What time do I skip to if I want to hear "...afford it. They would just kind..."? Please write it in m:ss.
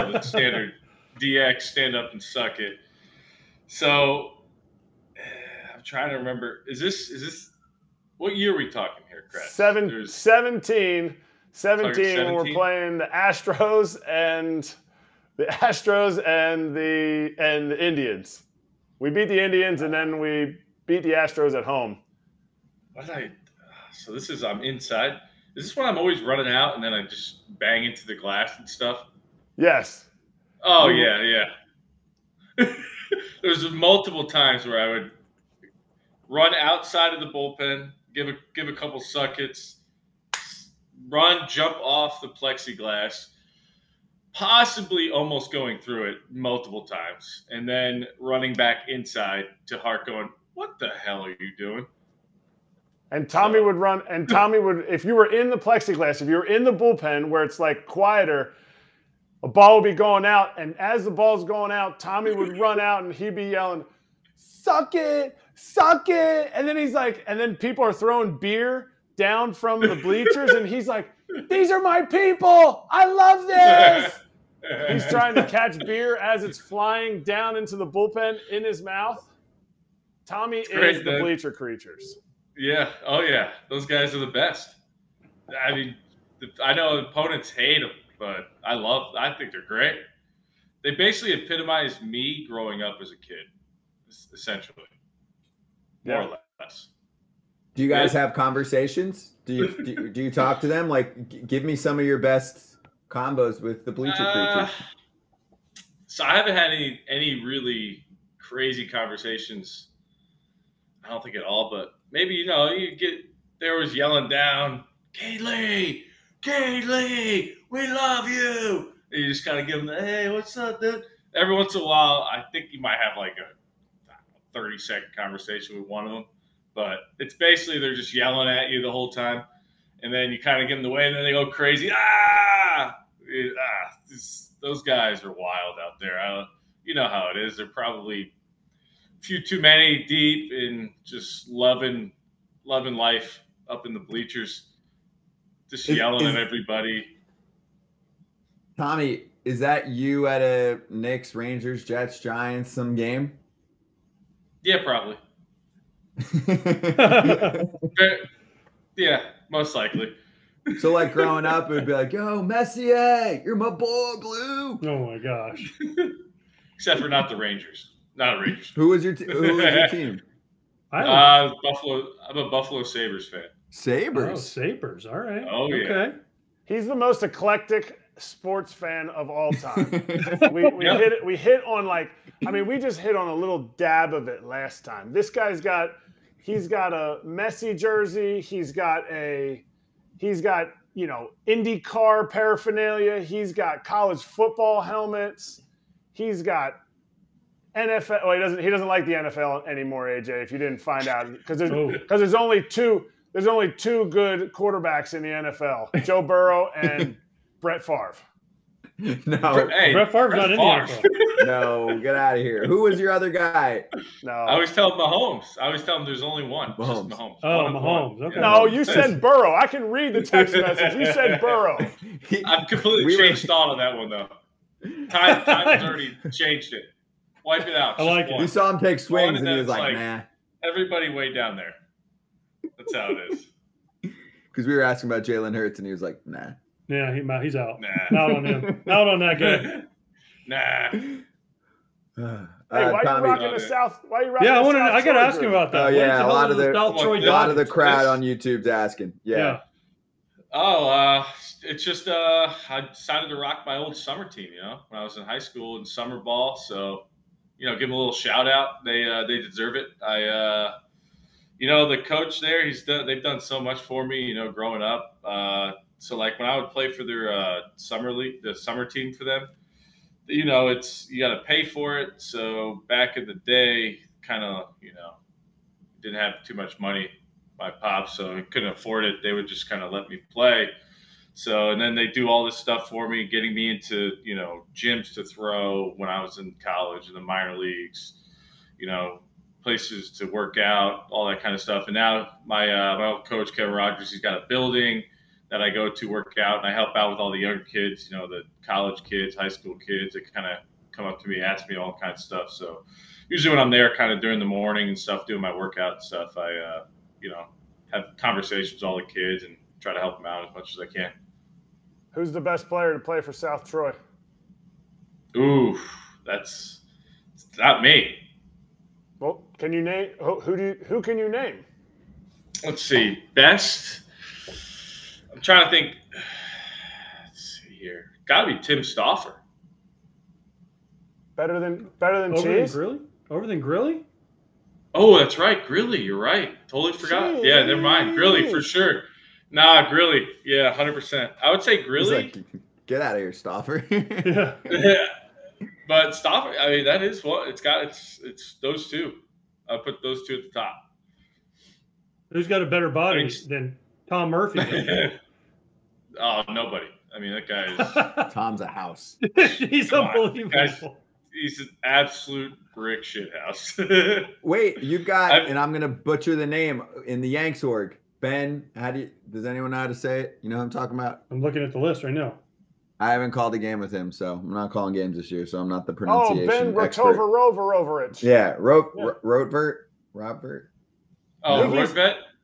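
4:38.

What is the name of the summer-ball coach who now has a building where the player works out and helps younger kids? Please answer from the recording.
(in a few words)
Kevin Rogers.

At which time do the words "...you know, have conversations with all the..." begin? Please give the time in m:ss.
5:07.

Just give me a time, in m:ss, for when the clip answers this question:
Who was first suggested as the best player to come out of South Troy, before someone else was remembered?
5:28.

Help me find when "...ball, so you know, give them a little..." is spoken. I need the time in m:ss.
4:16.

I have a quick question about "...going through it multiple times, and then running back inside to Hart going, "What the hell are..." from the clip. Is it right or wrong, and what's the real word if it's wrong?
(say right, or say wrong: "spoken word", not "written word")
right.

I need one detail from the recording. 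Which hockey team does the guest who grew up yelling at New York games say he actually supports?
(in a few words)
Buffalo Sabres.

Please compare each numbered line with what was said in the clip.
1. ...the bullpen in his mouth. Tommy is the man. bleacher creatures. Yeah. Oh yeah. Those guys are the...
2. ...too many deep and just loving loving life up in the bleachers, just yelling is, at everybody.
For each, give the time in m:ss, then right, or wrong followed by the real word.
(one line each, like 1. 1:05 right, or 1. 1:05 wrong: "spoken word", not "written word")
1. 1:17 right
2. 2:19 right.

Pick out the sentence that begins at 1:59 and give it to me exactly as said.
And you just kind of give them, the, hey, what's up, dude?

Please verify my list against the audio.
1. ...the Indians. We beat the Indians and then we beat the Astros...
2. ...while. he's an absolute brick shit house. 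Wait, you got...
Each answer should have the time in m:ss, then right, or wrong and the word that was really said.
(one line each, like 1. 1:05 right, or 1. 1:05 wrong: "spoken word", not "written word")
1. 0:17 right
2. 6:00 wrong: "unbelievable", not "while".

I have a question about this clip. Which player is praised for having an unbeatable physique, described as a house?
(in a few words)
Tom Murphy.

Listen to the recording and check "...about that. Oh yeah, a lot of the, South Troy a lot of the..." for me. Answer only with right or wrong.
right.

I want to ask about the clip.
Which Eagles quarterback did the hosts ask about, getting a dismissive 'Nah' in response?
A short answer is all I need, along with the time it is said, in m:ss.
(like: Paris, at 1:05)
Jalen Hurts, at 3:55.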